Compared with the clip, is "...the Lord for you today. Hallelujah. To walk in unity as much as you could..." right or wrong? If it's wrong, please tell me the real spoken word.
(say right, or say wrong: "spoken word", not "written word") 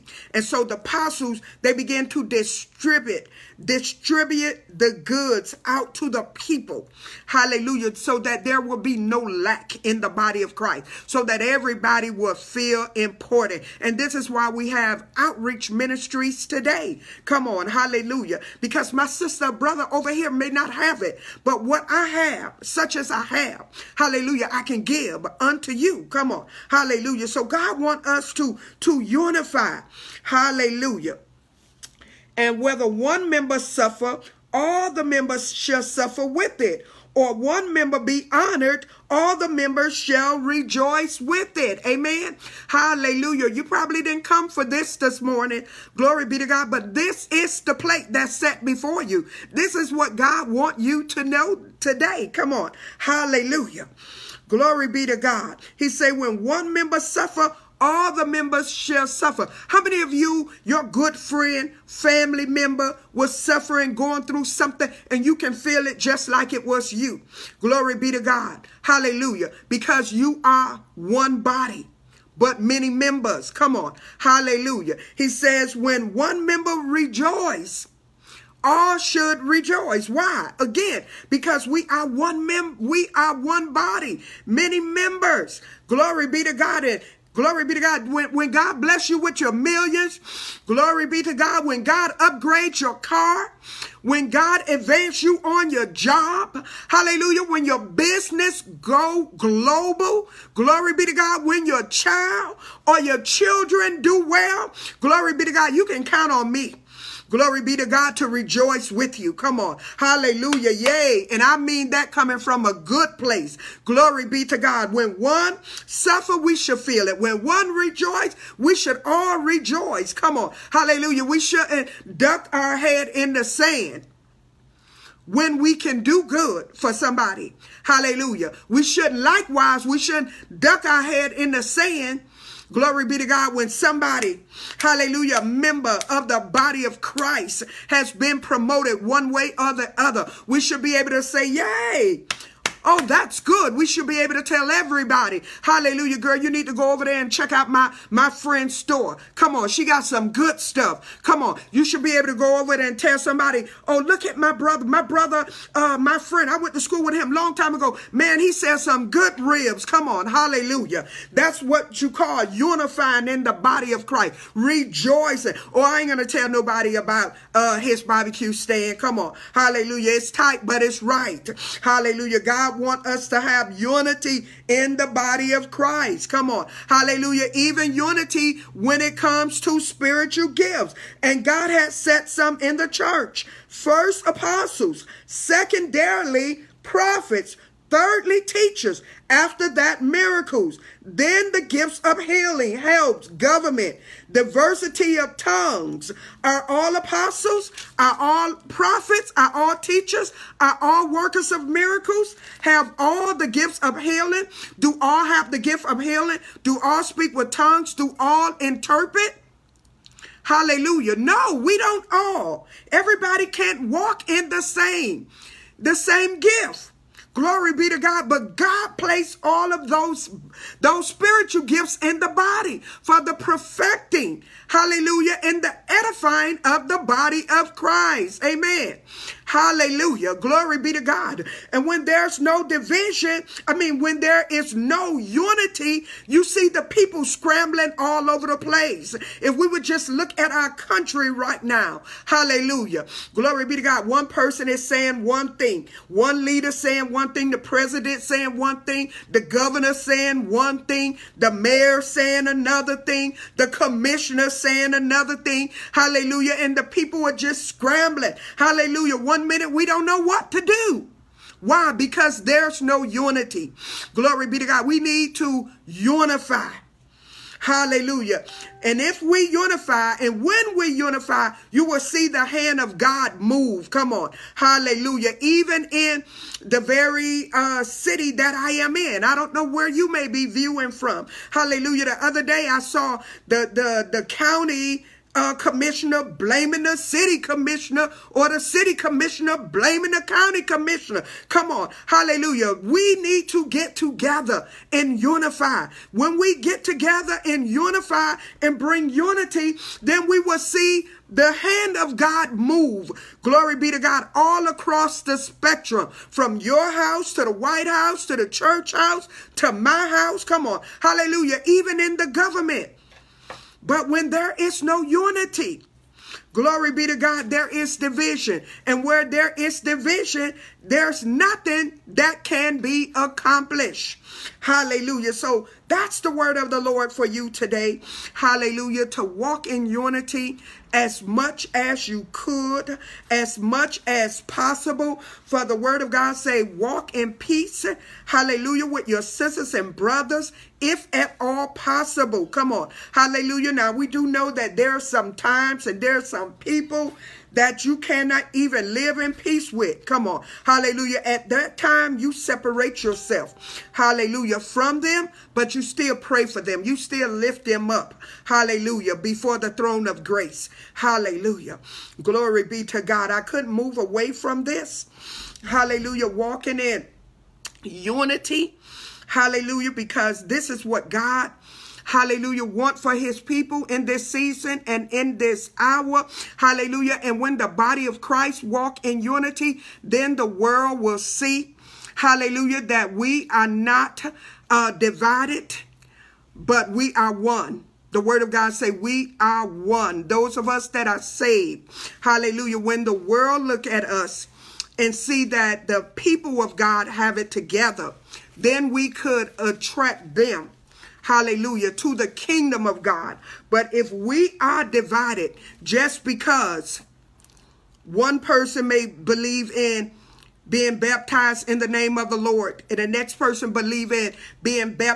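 right.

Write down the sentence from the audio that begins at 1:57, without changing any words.
When one rejoice, we should all rejoice.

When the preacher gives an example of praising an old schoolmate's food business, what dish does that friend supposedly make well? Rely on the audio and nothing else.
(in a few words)
ribs.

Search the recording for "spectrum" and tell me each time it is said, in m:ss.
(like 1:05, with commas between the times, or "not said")
5:05.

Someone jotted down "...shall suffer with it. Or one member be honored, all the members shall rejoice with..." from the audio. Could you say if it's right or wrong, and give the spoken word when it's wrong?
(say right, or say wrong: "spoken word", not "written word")
right.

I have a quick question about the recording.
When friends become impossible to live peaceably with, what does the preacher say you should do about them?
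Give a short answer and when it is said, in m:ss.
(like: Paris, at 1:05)
separate yourself, at 5:52.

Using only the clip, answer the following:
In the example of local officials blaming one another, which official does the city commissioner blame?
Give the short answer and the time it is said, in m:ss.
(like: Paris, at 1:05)
the county commissioner, at 4:50.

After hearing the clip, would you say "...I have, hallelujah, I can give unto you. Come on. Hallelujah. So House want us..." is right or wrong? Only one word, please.
wrong.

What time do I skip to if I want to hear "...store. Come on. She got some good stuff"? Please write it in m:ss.
2:28.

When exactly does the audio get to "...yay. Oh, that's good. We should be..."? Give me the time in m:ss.
2:21.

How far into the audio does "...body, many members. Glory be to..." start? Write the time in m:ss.
1:23.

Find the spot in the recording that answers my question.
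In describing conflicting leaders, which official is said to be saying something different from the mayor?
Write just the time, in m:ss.
4:13.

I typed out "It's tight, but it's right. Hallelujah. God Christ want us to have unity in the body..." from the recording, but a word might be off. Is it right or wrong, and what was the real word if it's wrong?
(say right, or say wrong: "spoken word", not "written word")
wrong: "God", not "Christ".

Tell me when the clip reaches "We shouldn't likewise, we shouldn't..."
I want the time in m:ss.
2:08.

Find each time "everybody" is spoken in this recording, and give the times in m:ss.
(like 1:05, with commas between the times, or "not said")
0:11, 2:24, 3:32.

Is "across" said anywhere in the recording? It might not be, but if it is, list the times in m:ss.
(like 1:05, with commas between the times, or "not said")
5:04.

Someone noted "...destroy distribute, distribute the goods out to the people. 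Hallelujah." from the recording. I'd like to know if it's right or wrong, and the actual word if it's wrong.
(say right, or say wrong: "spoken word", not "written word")
right.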